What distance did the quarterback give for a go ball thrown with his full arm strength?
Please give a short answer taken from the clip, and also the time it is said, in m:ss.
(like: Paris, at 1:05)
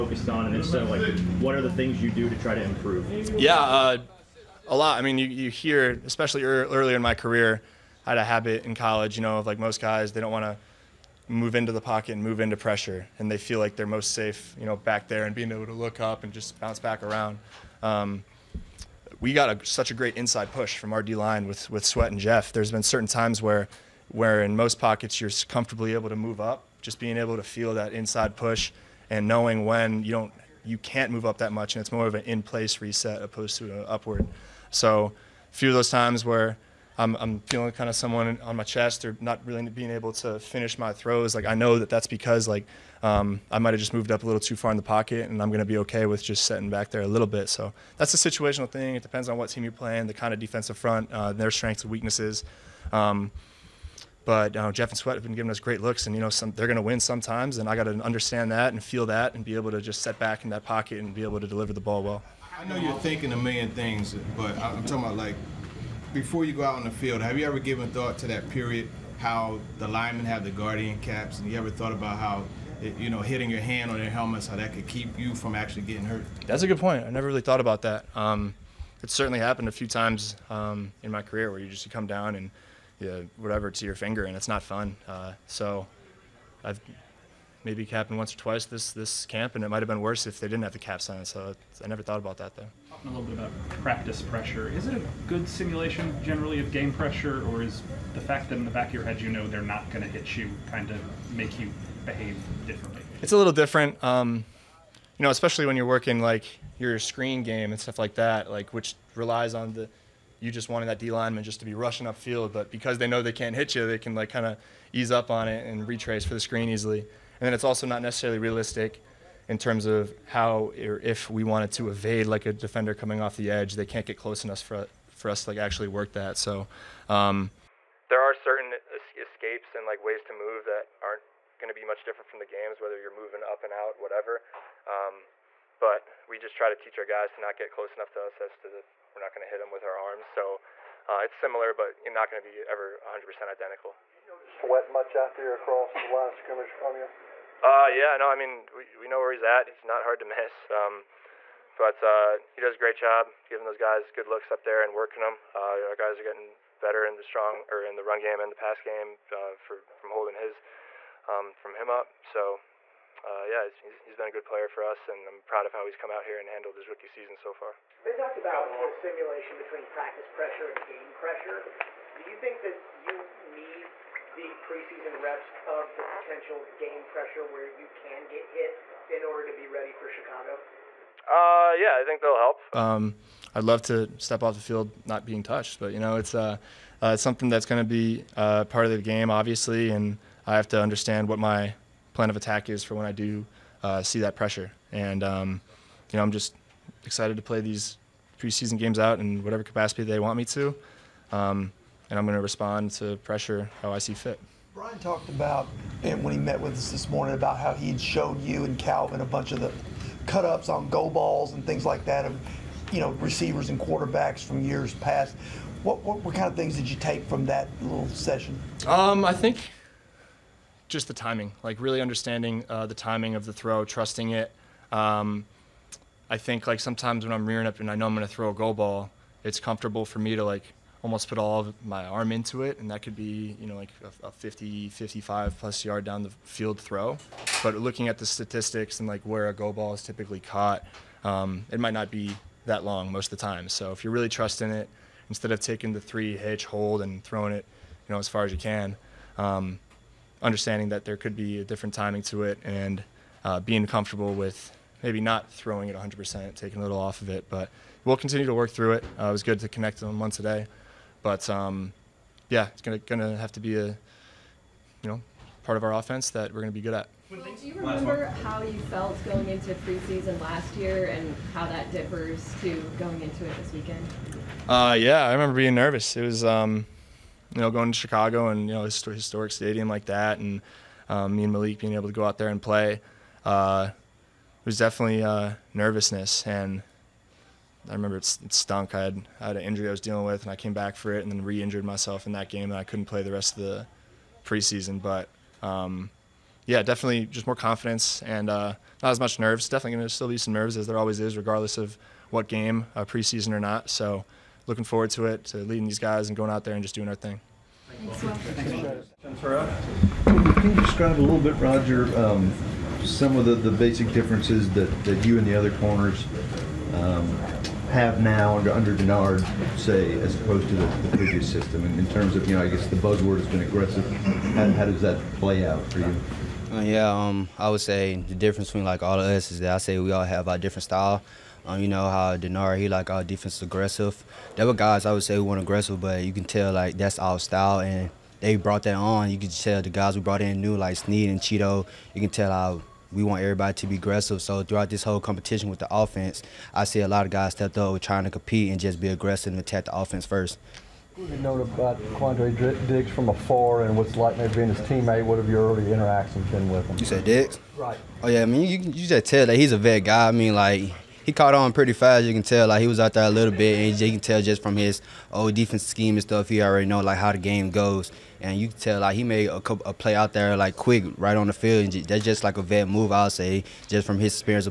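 50, 55 plus yard, at 3:54.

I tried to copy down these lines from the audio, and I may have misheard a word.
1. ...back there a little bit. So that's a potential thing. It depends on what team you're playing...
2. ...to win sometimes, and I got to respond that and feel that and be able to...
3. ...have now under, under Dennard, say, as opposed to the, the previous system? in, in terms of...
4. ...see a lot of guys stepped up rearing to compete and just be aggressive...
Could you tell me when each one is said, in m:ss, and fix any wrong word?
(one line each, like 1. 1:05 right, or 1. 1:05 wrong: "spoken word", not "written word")
1. 0:46 wrong: "situational", not "potential"
2. 0:56 wrong: "understand", not "respond"
3. 5:17 right
4. 5:46 wrong: "trying", not "rearing".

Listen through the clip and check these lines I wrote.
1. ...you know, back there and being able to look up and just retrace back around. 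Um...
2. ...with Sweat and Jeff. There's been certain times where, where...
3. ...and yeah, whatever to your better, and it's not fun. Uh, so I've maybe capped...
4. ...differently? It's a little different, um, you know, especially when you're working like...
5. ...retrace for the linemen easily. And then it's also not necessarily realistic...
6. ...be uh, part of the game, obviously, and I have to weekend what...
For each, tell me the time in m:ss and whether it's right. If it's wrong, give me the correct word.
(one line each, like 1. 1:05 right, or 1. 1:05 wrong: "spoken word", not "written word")
1. 0:14 wrong: "bounce", not "retrace"
2. 0:21 right
3. 1:22 wrong: "finger", not "better"
4. 1:42 right
5. 1:55 wrong: "screen", not "linemen"
6. 3:07 wrong: "understand", not "weekend".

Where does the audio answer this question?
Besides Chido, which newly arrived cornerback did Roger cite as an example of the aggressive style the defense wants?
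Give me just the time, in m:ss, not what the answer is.
5:40.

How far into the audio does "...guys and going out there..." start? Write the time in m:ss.
5:05.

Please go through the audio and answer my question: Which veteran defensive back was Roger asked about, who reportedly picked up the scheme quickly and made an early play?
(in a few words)
Quandre Diggs.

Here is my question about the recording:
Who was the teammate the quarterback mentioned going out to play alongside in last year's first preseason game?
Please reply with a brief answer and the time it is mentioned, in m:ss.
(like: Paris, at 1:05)
Malik, at 4:41.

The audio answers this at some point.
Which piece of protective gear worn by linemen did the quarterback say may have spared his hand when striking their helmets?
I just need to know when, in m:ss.
1:10.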